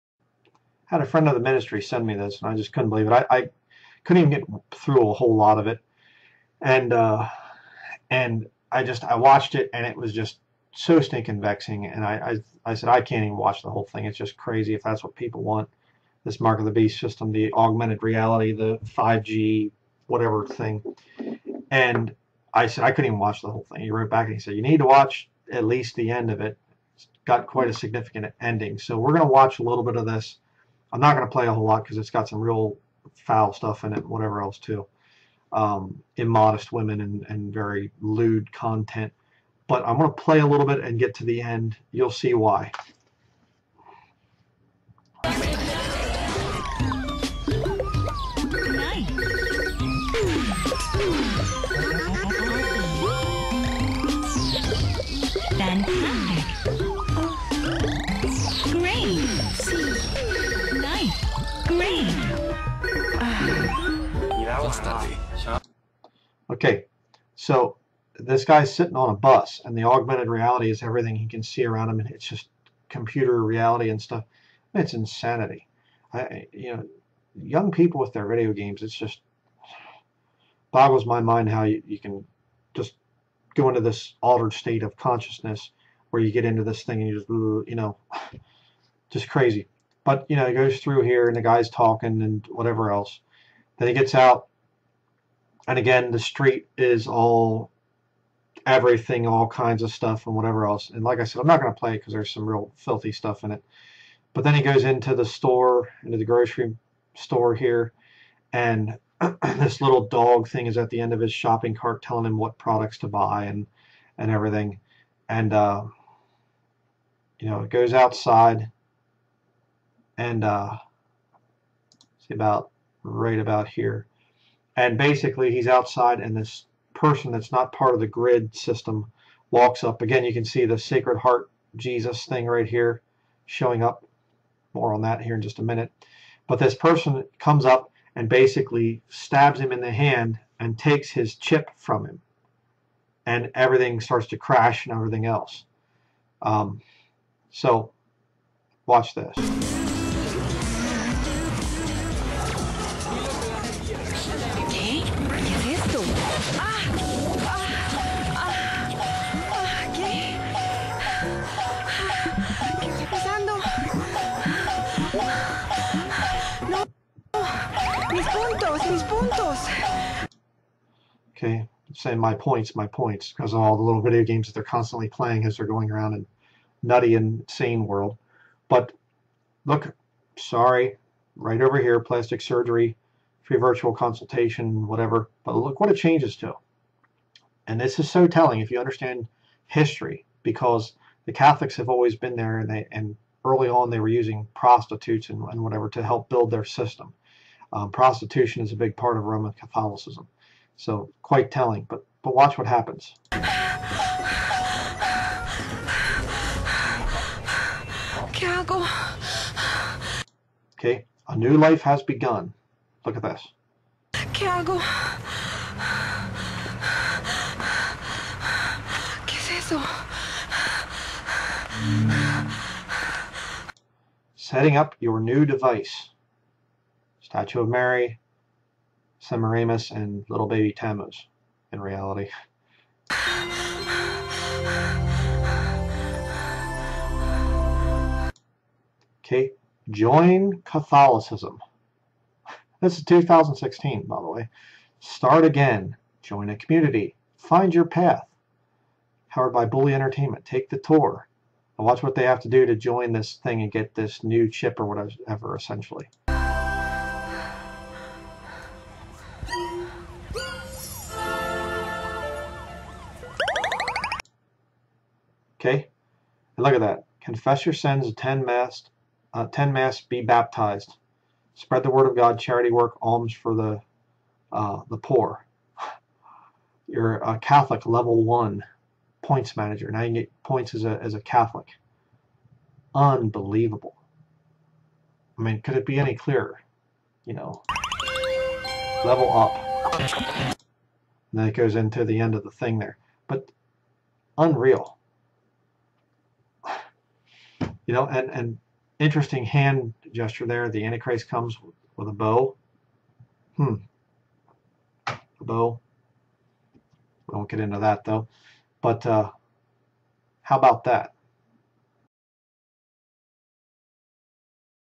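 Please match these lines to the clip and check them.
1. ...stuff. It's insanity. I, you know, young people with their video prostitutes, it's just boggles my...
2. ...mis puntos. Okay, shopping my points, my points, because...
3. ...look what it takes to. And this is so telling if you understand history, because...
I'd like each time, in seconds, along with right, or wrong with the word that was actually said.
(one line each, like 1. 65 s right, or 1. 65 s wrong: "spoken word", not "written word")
1. 74 s wrong: "games", not "prostitutes"
2. 168 s wrong: "saying", not "shopping"
3. 185 s wrong: "changes", not "takes".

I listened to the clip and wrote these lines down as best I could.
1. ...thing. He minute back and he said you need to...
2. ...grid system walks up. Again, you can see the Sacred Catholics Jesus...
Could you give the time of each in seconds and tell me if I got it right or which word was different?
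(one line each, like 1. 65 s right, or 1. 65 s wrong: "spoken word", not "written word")
1. 23 s wrong: "wrote", not "minute"
2. 128 s wrong: "Heart", not "Catholics".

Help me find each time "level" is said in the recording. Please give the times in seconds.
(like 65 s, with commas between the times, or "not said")
277 s, 289 s.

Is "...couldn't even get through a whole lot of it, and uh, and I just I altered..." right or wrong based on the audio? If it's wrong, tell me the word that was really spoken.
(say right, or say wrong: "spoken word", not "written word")
wrong: "watched", not "altered".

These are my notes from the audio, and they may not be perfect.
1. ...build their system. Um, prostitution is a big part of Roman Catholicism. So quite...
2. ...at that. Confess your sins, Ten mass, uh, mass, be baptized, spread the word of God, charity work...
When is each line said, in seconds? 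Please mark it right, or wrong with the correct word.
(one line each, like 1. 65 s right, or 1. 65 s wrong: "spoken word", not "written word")
1. 196 s right
2. 266 s right.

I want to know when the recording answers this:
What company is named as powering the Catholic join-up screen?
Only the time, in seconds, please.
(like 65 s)
249 s.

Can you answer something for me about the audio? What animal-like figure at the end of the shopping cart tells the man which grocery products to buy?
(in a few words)
little dog thing.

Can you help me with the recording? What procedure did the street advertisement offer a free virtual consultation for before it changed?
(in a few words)
plastic surgery.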